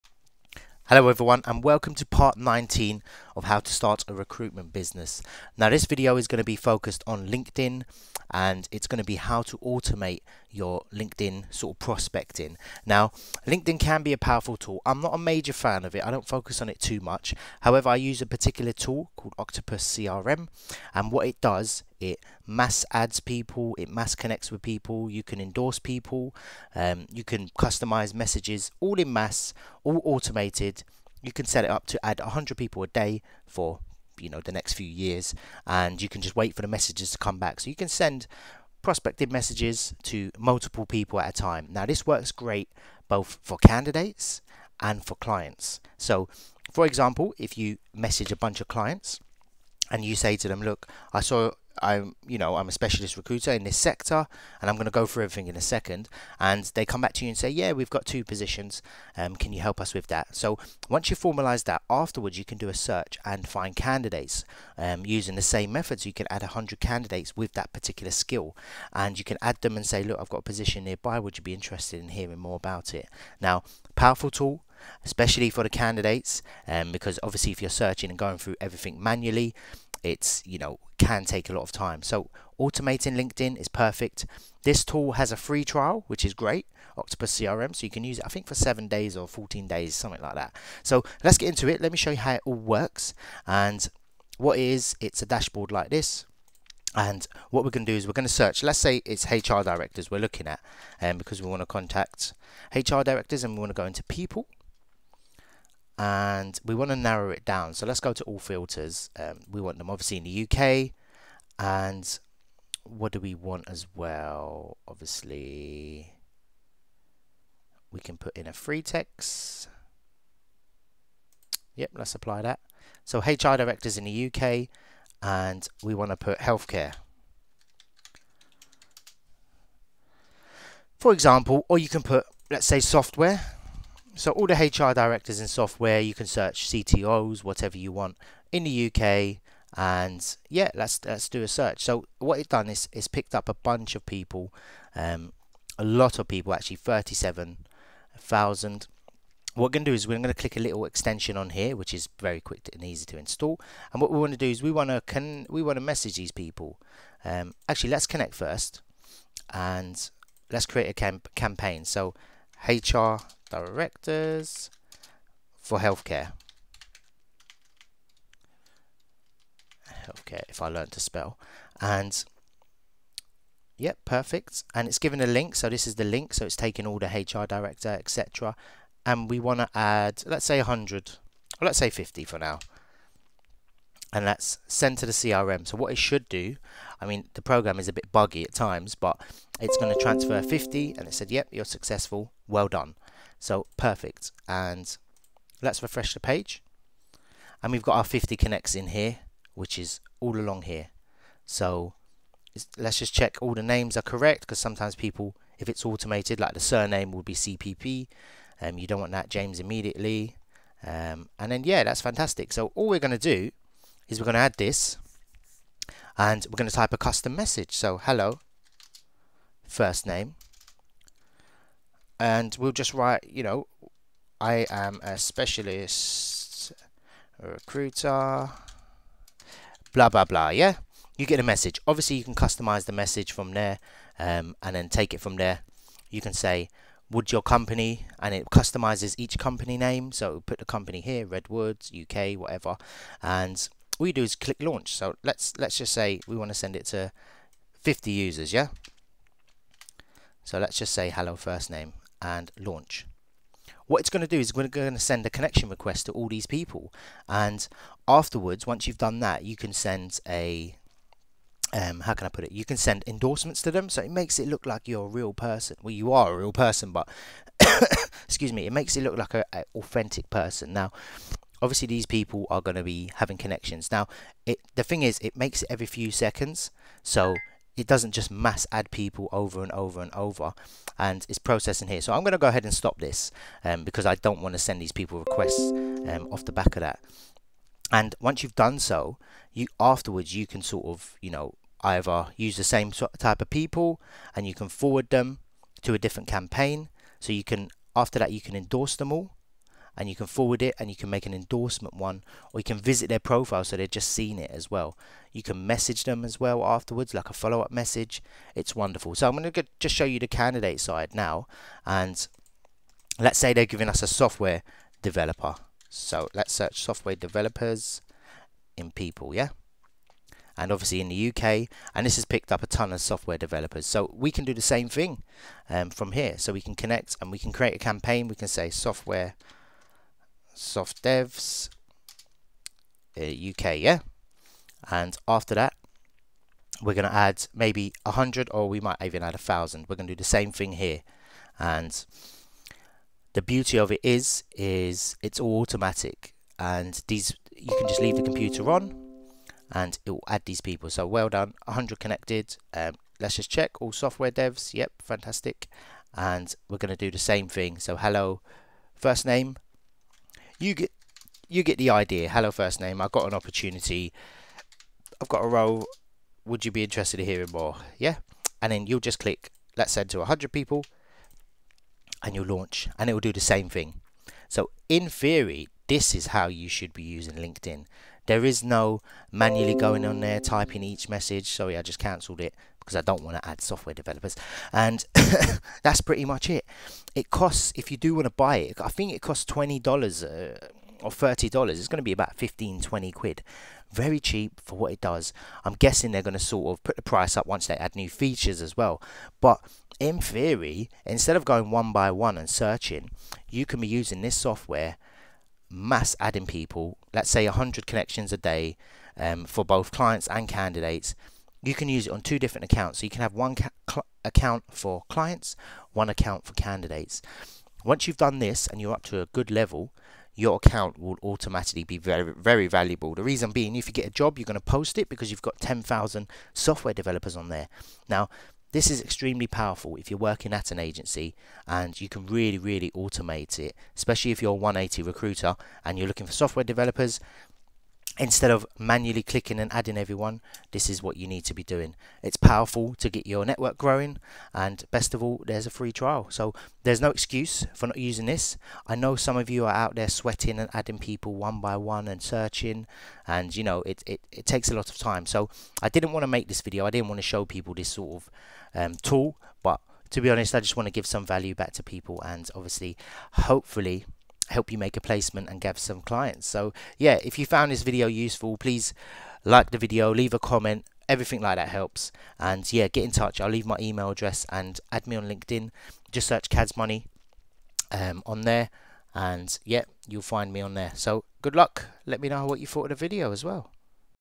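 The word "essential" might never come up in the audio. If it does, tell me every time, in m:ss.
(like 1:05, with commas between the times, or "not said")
not said.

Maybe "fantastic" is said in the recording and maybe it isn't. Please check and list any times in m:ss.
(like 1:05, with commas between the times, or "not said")
3:32, 5:55.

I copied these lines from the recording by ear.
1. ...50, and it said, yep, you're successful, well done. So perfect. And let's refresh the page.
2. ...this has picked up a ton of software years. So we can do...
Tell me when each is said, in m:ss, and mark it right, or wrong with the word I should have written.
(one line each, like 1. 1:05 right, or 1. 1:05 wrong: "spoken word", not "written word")
1. 3:10 right
2. 5:22 wrong: "developers", not "years".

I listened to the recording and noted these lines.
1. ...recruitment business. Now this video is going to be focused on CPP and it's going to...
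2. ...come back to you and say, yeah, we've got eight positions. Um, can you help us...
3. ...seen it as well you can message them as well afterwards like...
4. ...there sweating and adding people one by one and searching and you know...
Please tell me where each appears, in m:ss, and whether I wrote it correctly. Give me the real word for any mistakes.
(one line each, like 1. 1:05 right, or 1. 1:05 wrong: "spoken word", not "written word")
1. 0:04 wrong: "LinkedIn", not "CPP"
2. 0:56 wrong: "two", not "eight"
3. 5:04 right
4. 7:29 right.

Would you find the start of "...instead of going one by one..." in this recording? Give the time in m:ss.
6:41.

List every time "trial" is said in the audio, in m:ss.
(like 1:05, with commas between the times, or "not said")
1:25, 7:25.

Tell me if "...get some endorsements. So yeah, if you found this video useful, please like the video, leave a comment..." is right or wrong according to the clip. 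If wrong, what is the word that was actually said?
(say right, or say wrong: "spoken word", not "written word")
wrong: "clients", not "endorsements".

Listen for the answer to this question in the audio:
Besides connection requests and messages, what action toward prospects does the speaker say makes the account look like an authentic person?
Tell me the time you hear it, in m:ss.
4:23.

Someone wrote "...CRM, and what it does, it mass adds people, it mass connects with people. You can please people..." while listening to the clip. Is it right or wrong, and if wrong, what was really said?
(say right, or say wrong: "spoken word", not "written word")
wrong: "endorse", not "please".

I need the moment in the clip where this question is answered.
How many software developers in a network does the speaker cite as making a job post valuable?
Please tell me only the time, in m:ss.
7:05.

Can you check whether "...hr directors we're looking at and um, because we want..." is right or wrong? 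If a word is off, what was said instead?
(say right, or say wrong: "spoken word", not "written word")
right.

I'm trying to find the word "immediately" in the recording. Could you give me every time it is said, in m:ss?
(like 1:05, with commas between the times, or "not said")
3:29.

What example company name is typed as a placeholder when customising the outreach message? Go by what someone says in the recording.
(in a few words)
Redwoods UK.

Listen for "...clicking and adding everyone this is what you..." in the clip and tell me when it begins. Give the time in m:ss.
7:19.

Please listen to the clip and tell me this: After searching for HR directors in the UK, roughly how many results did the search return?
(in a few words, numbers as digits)
37,000.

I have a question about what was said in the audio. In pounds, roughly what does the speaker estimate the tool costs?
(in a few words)
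15 to 20 pounds.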